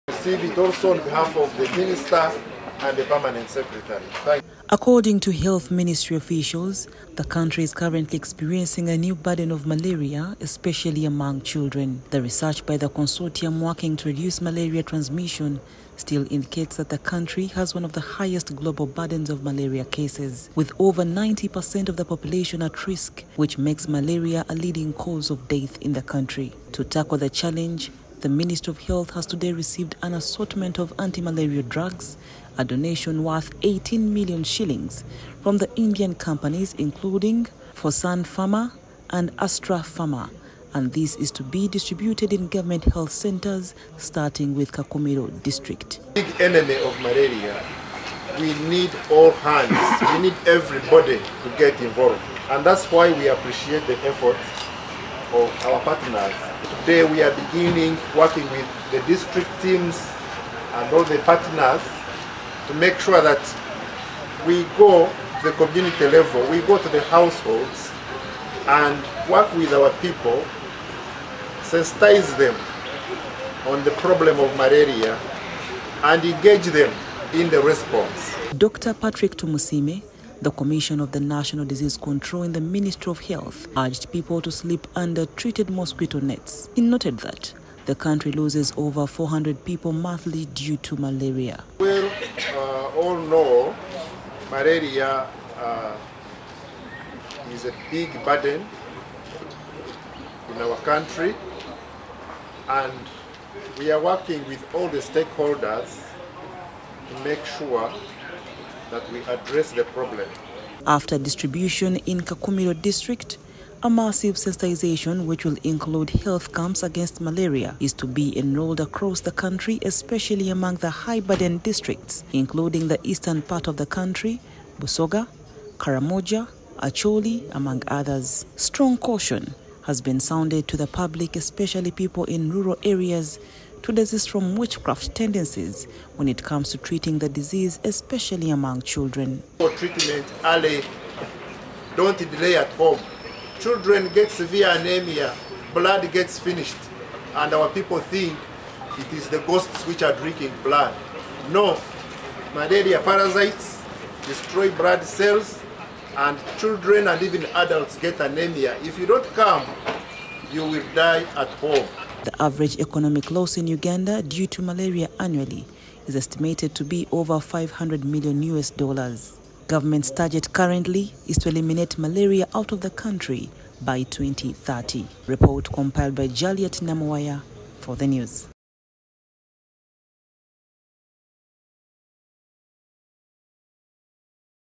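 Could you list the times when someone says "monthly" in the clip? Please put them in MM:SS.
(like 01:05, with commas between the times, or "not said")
01:29.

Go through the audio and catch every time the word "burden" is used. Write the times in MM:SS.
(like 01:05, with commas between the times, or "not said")
00:09, 00:18, 01:38, 02:01.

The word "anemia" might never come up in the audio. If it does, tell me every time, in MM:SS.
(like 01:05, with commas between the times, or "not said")
02:24, 02:38.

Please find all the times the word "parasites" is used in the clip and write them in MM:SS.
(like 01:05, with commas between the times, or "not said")
02:32.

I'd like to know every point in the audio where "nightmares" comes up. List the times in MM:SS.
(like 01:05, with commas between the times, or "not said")
not said.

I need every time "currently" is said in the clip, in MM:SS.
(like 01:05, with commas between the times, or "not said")
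00:07, 02:50.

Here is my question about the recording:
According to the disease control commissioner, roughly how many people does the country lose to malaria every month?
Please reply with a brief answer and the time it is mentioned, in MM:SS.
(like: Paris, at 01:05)
over 400, at 01:28.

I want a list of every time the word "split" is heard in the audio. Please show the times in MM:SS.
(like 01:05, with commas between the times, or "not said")
not said.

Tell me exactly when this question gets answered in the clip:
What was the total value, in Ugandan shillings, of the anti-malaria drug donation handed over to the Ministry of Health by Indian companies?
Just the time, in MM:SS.
00:33.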